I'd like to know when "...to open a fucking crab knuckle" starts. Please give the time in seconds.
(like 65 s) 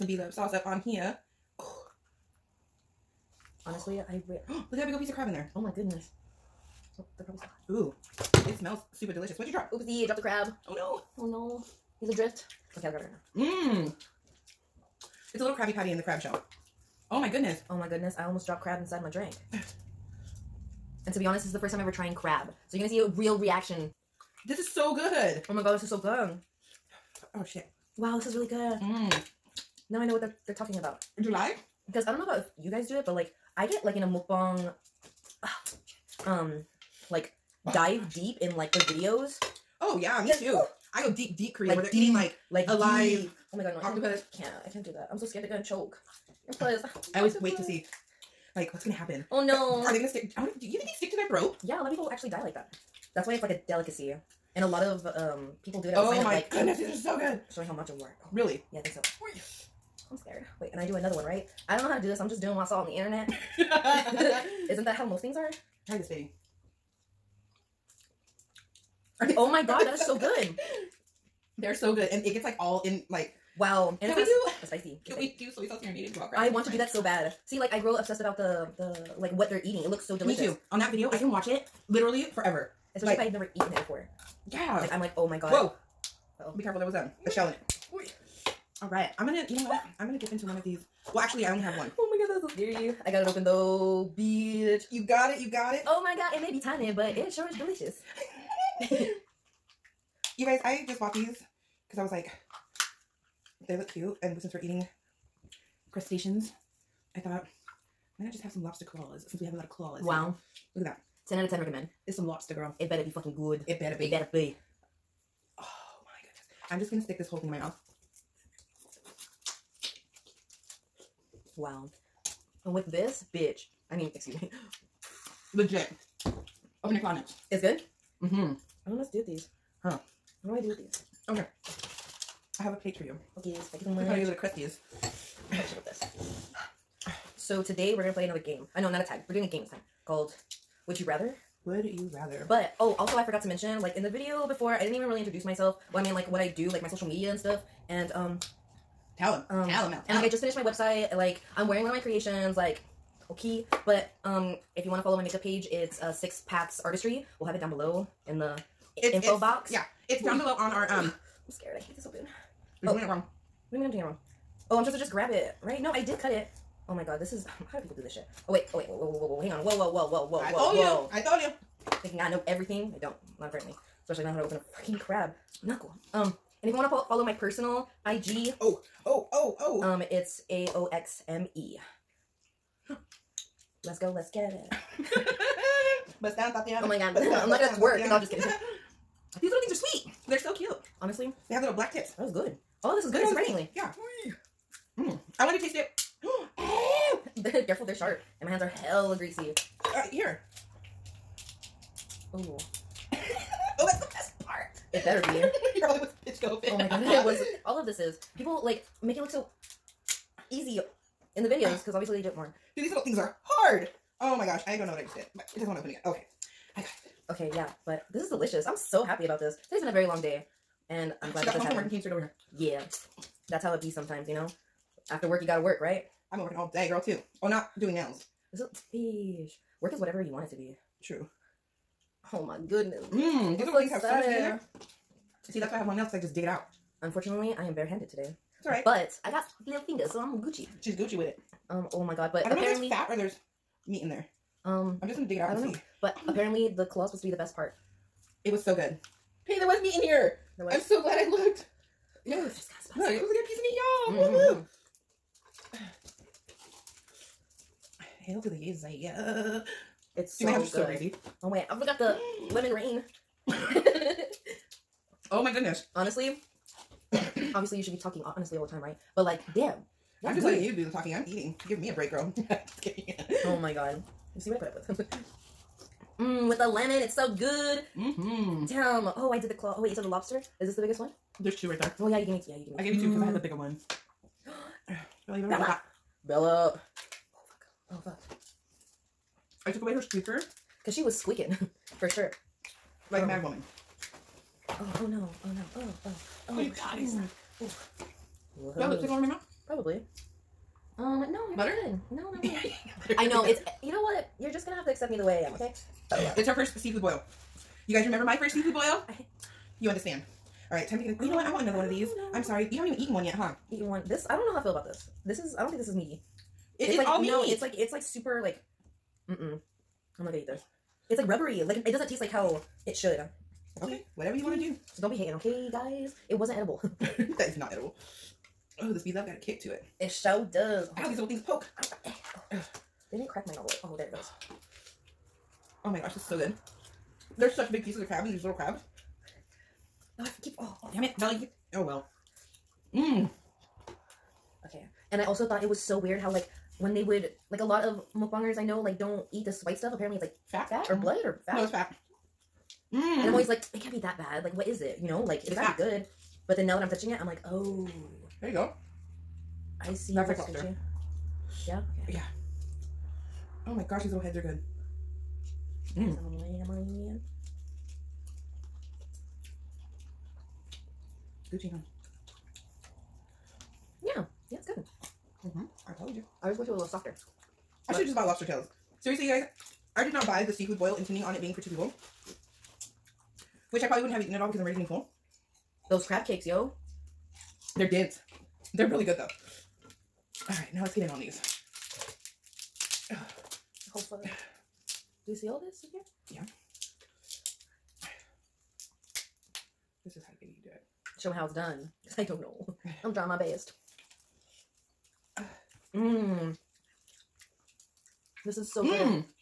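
174 s.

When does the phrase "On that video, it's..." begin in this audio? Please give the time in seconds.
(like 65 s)
80 s.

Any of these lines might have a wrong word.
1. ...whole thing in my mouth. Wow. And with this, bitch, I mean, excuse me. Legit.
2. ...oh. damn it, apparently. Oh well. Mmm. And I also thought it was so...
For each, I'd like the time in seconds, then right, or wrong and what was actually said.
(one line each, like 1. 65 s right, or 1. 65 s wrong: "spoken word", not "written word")
1. 117 s right
2. 340 s wrong: "belly", not "apparently".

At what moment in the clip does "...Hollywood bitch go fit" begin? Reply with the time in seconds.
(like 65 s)
205 s.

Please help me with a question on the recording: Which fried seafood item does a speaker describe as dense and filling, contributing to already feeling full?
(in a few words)
Crab cakes.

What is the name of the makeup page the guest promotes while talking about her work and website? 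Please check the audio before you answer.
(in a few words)
Six Paths Artistry.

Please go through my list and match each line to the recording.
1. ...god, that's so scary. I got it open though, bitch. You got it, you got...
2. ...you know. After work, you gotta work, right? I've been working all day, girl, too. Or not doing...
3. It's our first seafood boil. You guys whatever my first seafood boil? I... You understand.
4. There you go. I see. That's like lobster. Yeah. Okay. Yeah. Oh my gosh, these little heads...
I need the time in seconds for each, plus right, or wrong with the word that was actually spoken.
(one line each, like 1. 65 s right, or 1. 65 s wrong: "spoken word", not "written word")
1. 92 s right
2. 224 s right
3. 306 s wrong: "remember", not "whatever"
4. 358 s right.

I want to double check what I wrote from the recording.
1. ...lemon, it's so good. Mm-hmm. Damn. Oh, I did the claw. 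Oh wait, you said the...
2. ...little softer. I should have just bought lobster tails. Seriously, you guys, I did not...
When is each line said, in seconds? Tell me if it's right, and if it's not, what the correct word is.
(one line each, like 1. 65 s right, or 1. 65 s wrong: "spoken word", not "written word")
1. 276 s right
2. 376 s right.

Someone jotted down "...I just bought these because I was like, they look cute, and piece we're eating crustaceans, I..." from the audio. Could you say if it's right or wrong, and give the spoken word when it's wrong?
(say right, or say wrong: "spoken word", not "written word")
wrong: "since", not "piece".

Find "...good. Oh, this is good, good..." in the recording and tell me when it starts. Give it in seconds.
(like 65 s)
192 s.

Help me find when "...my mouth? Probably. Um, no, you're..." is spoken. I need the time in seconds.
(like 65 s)
299 s.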